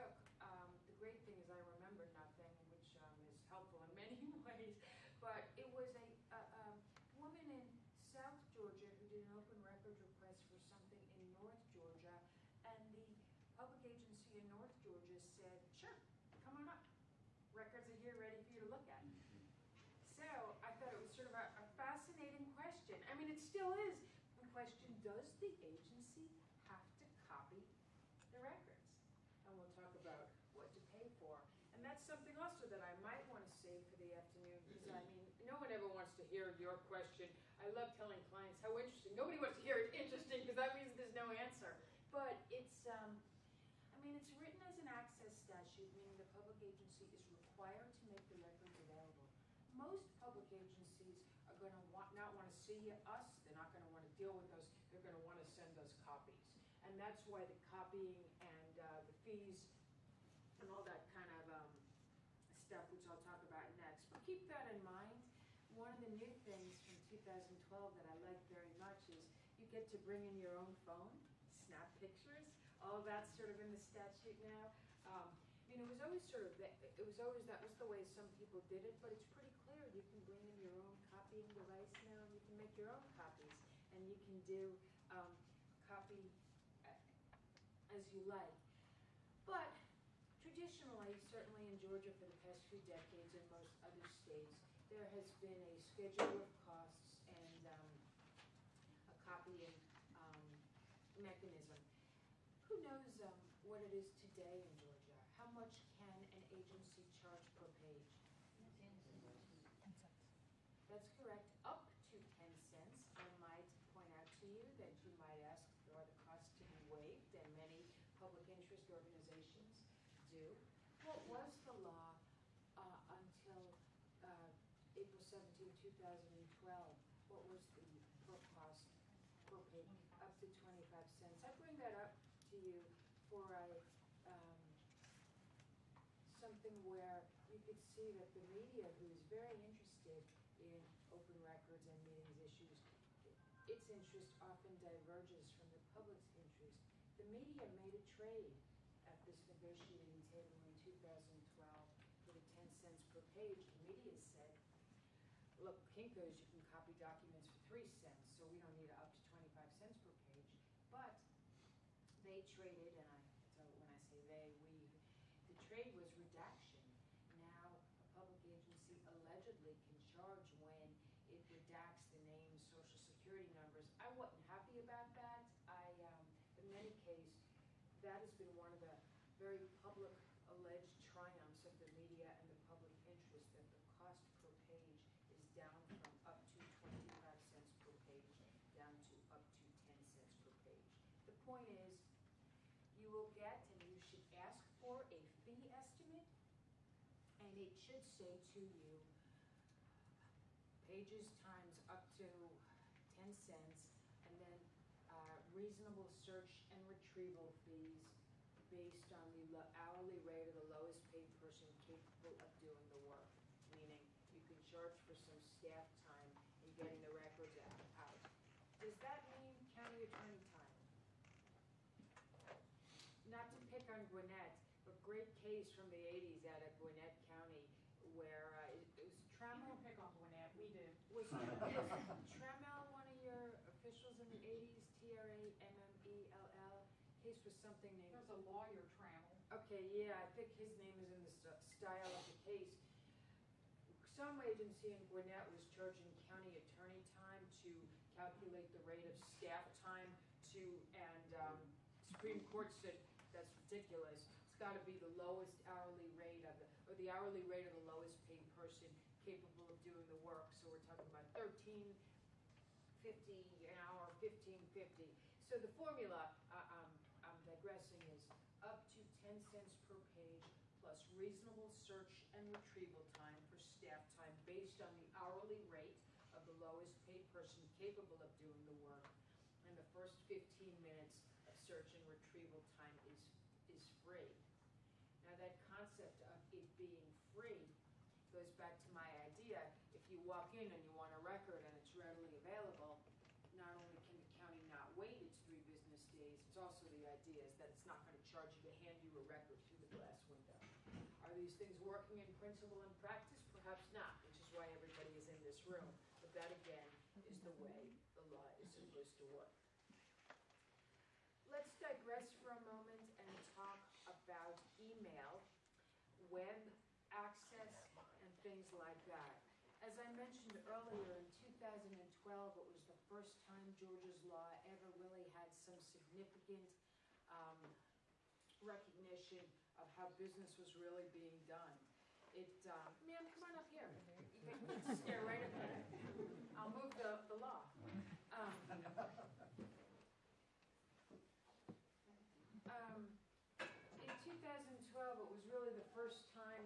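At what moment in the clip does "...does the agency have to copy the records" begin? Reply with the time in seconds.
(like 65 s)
25 s.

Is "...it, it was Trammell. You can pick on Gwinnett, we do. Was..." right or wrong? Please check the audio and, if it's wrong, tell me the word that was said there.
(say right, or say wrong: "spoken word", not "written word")
right.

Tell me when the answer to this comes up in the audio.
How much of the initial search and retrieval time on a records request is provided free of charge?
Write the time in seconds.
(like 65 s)
279 s.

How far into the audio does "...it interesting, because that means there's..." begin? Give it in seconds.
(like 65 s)
39 s.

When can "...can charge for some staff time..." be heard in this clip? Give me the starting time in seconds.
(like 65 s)
214 s.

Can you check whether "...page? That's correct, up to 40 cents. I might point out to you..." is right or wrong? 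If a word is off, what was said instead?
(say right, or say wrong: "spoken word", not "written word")
wrong: "10", not "40".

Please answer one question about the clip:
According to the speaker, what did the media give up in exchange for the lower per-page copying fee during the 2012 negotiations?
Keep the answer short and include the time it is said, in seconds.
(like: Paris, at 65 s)
Redaction, at 165 s.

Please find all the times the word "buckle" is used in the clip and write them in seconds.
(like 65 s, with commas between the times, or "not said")
not said.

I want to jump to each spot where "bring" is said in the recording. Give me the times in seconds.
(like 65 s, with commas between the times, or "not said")
69 s, 80 s, 131 s.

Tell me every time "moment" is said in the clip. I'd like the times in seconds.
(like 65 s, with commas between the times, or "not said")
312 s.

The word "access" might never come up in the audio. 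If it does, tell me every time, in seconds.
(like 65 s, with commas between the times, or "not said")
44 s, 317 s.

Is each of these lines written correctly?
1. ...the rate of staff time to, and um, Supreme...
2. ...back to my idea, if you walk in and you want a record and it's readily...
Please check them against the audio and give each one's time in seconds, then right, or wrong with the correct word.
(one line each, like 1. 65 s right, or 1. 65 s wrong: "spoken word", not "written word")
1. 248 s right
2. 288 s right.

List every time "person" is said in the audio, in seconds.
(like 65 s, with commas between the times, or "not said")
211 s, 258 s, 277 s.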